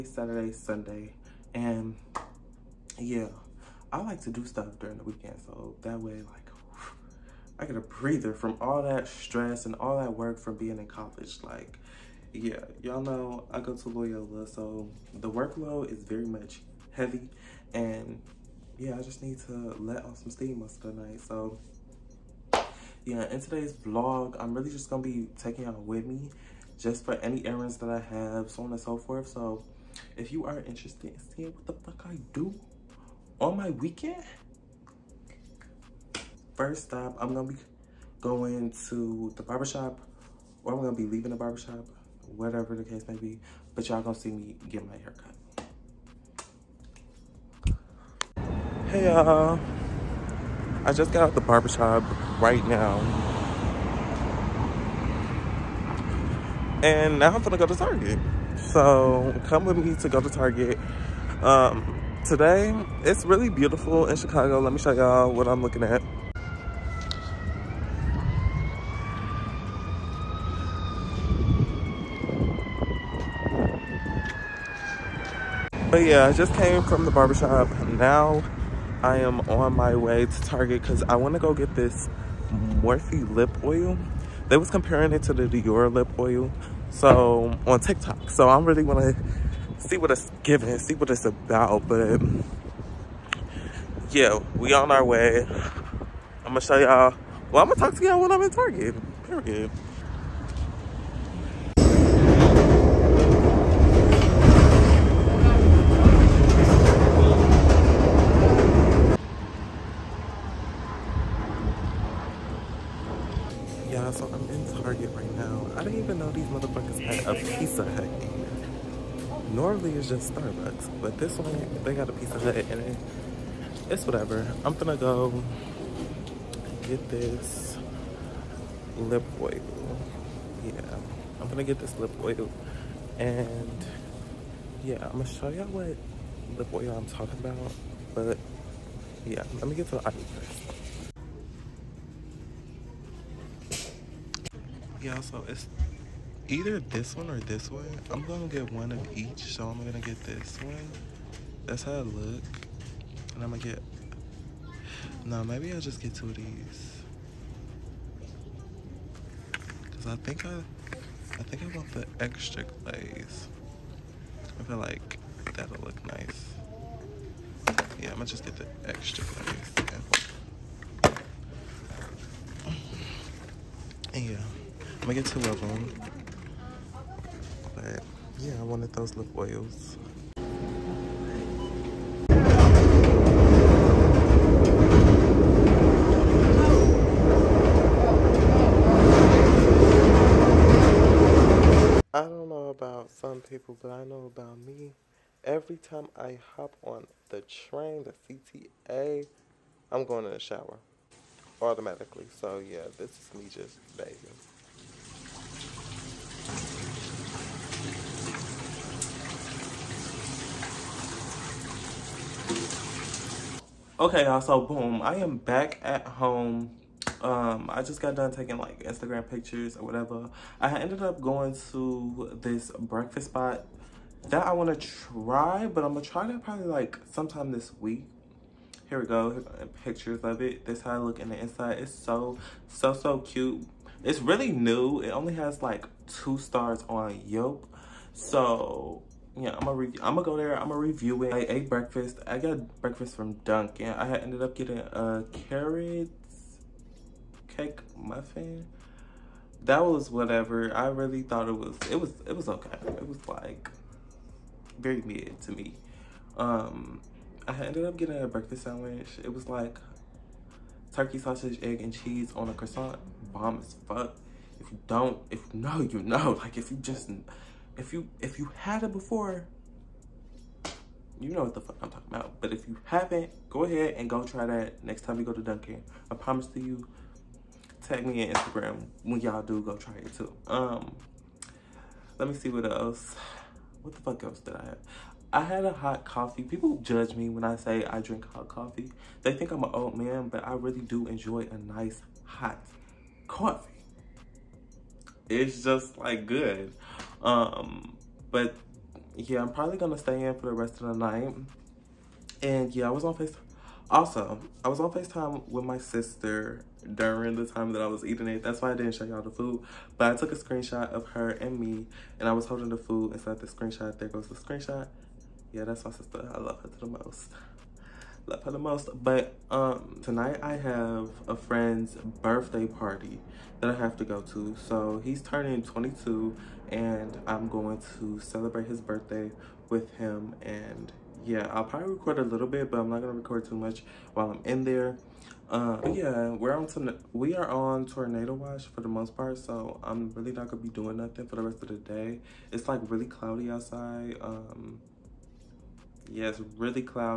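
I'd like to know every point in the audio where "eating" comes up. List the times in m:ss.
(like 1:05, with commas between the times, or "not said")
5:08.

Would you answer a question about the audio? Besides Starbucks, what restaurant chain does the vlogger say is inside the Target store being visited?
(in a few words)
Pizza Hut.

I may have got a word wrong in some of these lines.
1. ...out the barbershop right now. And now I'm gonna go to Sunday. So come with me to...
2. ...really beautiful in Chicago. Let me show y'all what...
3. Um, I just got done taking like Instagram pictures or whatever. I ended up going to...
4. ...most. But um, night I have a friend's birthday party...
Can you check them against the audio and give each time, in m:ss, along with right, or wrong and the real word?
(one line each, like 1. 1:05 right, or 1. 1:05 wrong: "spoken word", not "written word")
1. 0:51 wrong: "Target", not "Sunday"
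2. 1:03 right
3. 3:37 right
4. 5:18 wrong: "tonight", not "night".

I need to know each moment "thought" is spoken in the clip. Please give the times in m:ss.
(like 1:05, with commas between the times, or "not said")
4:11.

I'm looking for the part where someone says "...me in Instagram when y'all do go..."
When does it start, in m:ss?
4:38.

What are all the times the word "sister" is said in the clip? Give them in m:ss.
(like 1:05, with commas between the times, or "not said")
5:05, 5:15.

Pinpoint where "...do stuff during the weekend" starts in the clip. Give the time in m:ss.
0:04.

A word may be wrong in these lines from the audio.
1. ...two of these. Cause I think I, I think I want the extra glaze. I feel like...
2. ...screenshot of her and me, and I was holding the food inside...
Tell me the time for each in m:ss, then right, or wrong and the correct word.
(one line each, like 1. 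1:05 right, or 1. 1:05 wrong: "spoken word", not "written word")
1. 2:36 right
2. 5:10 right.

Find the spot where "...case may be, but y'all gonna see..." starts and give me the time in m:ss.
0:42.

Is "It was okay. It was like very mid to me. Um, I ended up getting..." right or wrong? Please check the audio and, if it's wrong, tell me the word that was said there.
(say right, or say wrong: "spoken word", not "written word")
right.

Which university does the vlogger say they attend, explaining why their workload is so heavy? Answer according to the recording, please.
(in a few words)
Loyola.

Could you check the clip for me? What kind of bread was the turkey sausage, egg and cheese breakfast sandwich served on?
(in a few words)
croissant.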